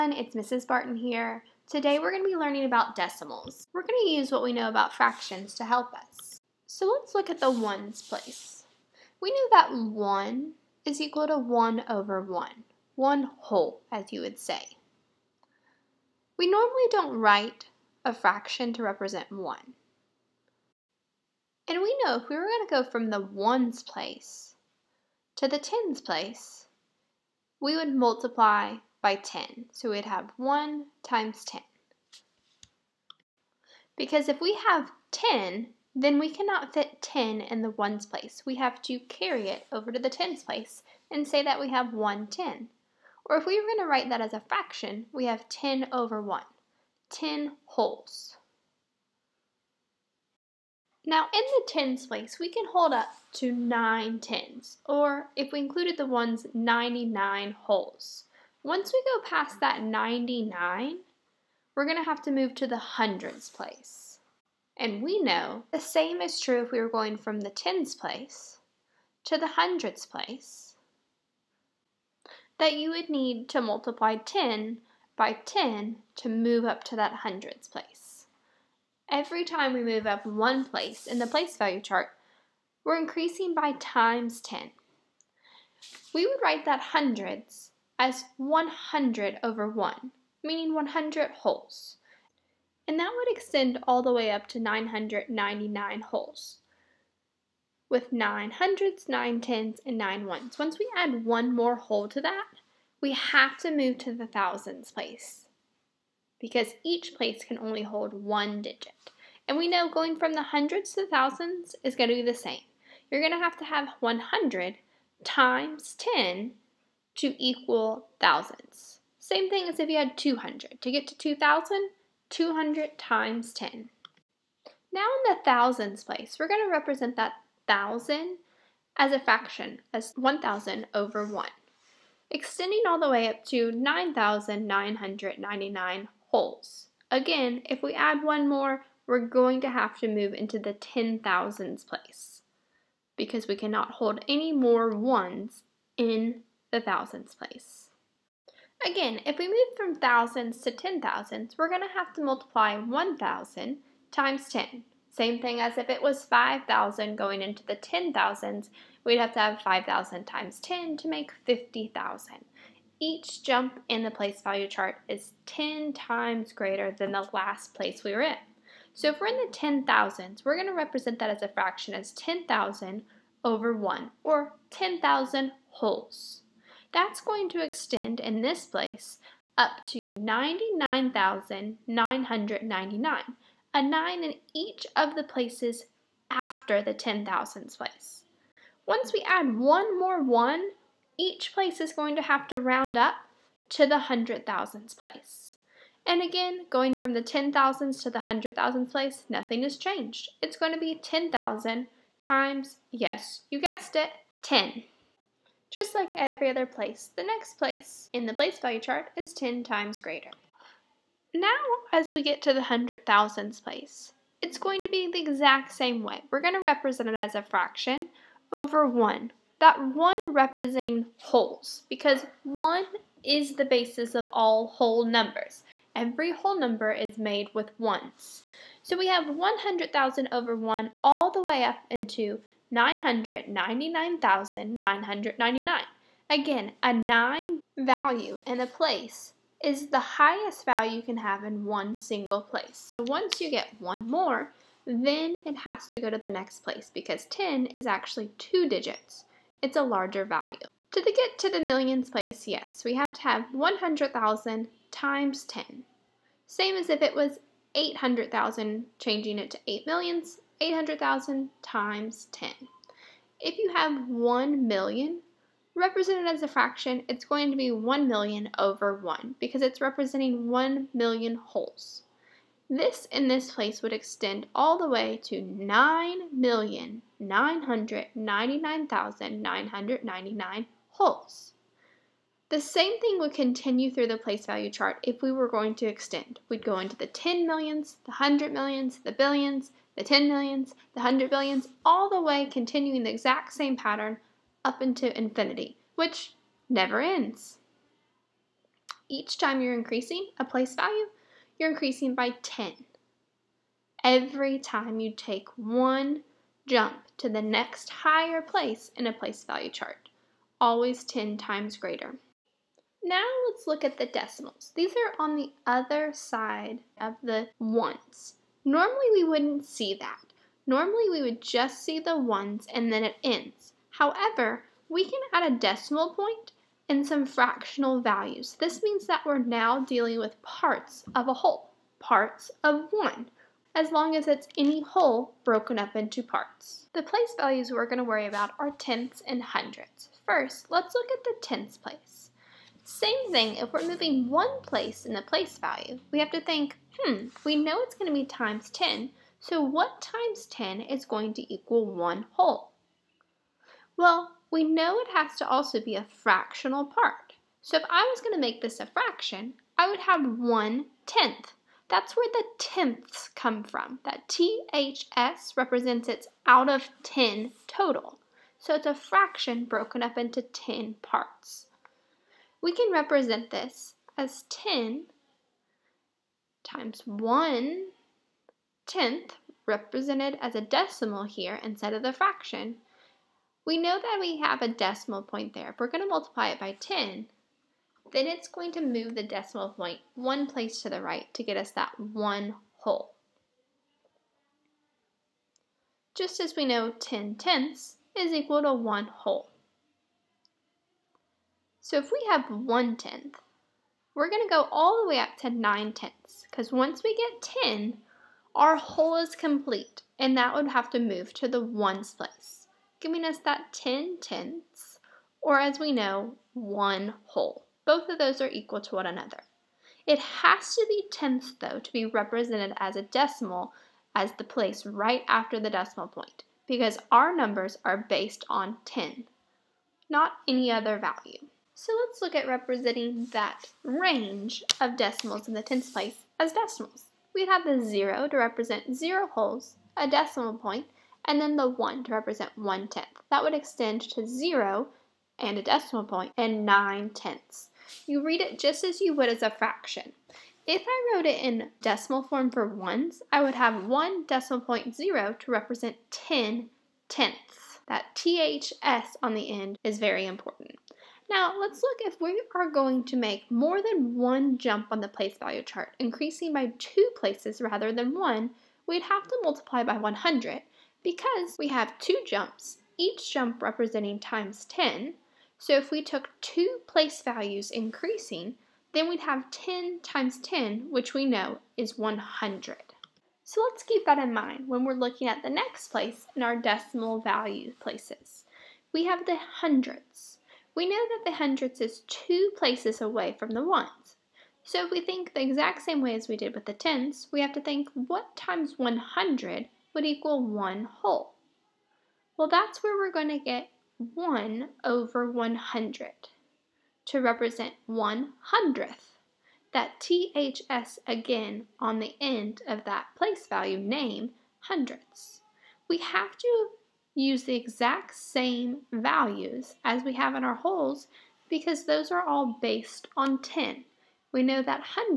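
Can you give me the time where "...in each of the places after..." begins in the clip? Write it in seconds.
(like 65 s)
184 s.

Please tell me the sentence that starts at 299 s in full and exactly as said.
Each time you're increasing a place value, you're increasing by 10.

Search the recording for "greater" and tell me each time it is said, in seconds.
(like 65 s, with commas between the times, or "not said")
166 s, 209 s, 311 s.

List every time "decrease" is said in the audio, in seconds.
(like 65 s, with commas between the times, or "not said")
not said.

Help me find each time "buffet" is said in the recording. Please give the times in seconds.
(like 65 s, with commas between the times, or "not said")
not said.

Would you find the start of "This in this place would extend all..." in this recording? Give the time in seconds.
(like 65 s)
272 s.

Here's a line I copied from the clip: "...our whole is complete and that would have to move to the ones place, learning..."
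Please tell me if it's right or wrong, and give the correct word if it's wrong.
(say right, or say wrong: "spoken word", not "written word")
wrong: "giving", not "learning".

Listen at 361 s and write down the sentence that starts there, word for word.
That's where the tenths come from.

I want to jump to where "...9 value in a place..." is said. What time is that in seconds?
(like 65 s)
236 s.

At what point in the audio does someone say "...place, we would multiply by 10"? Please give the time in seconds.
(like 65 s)
26 s.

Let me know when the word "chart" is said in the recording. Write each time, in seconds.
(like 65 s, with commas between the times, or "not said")
81 s, 164 s, 208 s, 284 s, 309 s, 465 s.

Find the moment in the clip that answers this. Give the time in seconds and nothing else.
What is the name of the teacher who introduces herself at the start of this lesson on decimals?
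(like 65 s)
0 s.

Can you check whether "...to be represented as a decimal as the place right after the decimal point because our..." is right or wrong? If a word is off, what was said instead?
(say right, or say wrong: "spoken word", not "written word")
right.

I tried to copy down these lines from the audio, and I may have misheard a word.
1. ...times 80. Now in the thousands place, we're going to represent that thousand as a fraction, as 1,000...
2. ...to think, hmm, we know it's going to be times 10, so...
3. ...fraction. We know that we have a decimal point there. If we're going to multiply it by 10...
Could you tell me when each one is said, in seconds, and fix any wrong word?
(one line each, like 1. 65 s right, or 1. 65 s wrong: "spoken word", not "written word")
1. 122 s wrong: "10", not "80"
2. 346 s right
3. 382 s right.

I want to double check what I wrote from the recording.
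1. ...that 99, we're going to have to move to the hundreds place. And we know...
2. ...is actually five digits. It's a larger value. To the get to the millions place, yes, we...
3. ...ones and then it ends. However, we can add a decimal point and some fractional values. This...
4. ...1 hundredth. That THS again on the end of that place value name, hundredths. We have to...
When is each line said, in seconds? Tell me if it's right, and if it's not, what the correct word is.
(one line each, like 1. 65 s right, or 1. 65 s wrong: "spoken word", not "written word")
1. 59 s right
2. 247 s wrong: "two", not "five"
3. 322 s right
4. 507 s right.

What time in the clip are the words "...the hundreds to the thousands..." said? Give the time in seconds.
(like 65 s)
110 s.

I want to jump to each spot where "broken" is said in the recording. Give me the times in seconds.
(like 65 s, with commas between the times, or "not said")
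335 s, 369 s.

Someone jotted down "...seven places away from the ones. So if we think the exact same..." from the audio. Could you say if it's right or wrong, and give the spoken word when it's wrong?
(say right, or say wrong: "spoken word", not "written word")
wrong: "two", not "seven".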